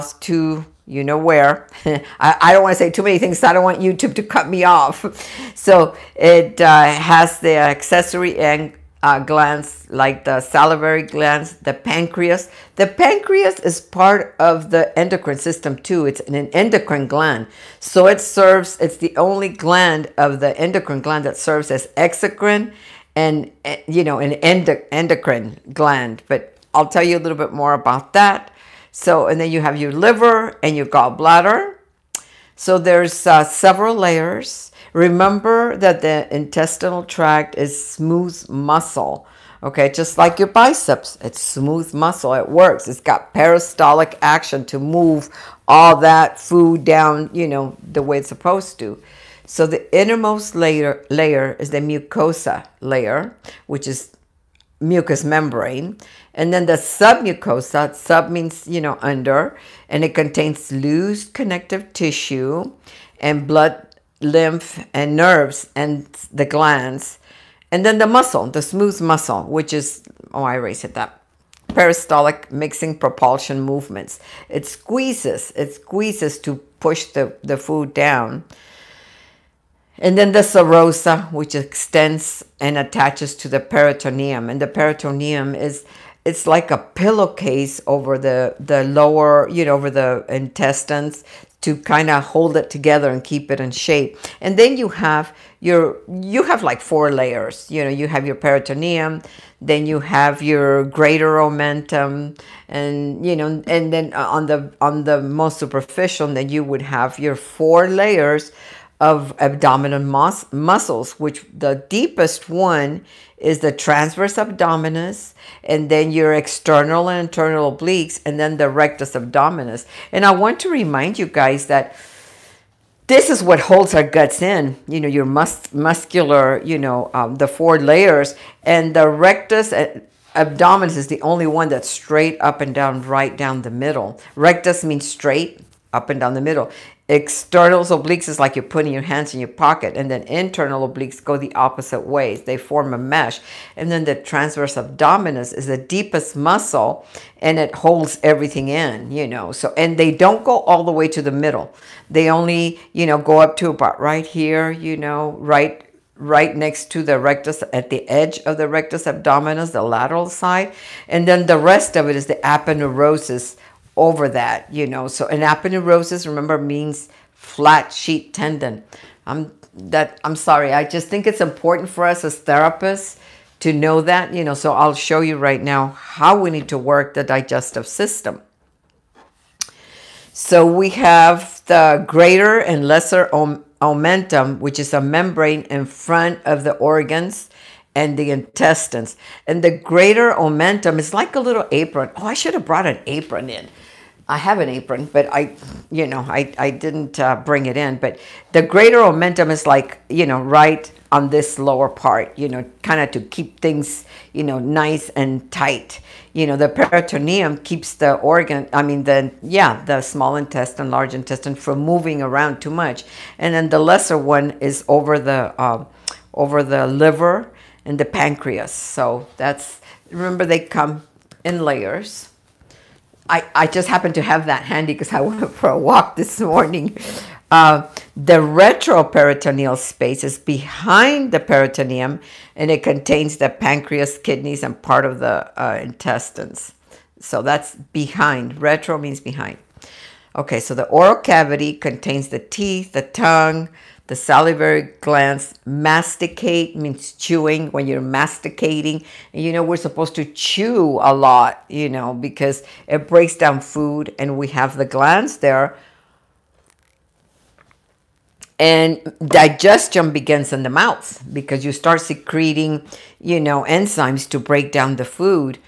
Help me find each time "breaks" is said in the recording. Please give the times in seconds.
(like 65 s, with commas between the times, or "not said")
253 s, 264 s.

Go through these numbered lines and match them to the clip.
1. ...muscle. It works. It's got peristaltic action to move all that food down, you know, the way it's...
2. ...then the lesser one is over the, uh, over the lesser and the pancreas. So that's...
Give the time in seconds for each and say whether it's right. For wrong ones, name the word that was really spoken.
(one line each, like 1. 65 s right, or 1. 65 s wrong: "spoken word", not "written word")
1. 41 s right
2. 213 s wrong: "liver", not "lesser".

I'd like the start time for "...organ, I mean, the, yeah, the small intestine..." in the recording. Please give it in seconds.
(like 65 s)
208 s.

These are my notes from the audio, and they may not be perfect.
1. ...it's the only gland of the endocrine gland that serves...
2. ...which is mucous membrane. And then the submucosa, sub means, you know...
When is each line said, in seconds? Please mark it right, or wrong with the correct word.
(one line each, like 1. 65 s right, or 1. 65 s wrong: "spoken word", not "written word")
1. 18 s right
2. 53 s right.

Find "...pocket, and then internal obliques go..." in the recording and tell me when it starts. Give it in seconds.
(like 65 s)
139 s.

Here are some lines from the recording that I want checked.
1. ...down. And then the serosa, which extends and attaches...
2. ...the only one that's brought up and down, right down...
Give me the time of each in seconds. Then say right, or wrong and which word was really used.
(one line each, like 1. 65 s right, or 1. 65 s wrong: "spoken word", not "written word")
1. 77 s right
2. 131 s wrong: "straight", not "brought".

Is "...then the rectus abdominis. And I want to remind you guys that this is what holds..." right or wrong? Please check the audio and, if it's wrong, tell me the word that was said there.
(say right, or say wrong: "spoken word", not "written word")
right.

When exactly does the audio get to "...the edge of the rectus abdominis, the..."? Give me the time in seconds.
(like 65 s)
157 s.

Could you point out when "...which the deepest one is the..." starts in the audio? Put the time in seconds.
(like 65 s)
111 s.